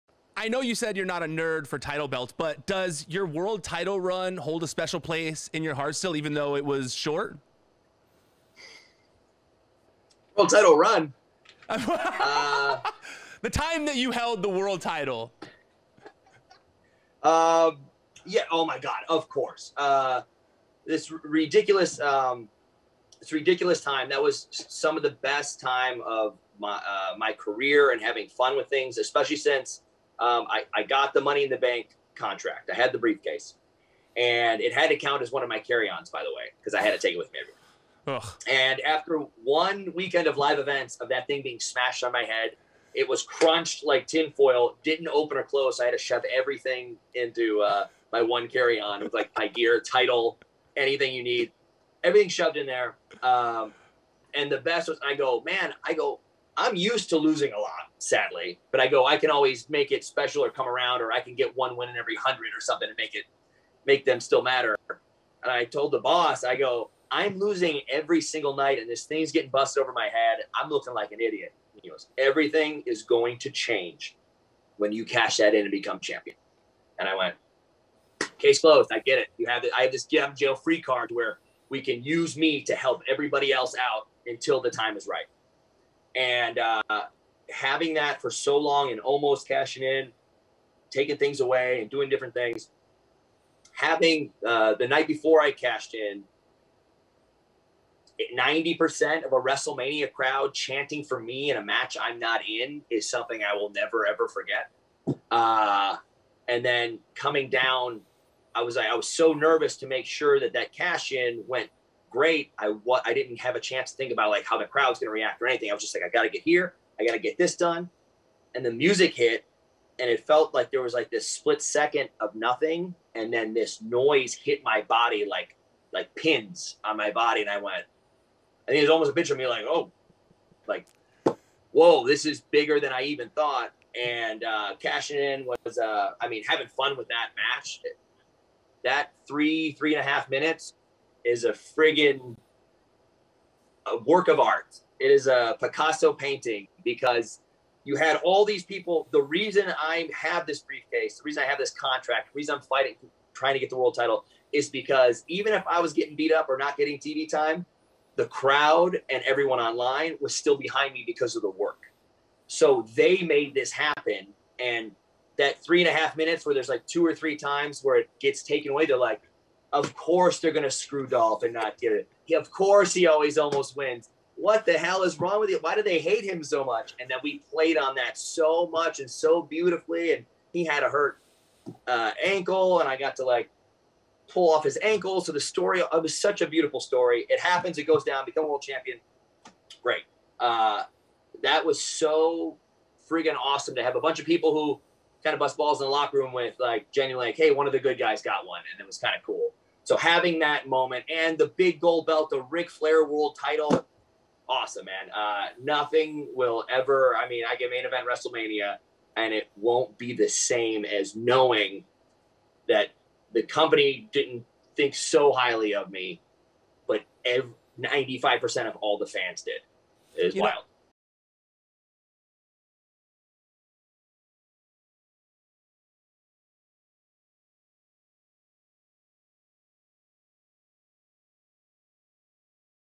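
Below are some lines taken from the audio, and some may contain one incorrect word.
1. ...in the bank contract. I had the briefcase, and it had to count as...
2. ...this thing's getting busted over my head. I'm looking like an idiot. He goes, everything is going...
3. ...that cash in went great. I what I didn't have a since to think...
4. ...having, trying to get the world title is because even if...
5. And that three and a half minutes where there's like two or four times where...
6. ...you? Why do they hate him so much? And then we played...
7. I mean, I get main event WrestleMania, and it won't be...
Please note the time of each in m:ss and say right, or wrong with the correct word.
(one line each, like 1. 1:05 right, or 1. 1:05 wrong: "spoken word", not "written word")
1. 0:31 right
2. 1:08 right
3. 1:50 wrong: "chance", not "since"
4. 2:32 wrong: "fighting", not "having"
5. 2:44 wrong: "three", not "four"
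6. 2:55 right
7. 3:27 right.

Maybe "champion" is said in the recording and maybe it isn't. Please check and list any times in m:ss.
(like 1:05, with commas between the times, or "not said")
1:15, 3:08.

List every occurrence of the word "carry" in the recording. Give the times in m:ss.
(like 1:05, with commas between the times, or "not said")
0:35, 0:48.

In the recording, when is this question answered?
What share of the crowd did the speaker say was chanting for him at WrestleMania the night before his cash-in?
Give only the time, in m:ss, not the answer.
1:38.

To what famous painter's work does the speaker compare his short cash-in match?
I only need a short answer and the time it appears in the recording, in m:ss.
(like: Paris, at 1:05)
Picasso, at 2:25.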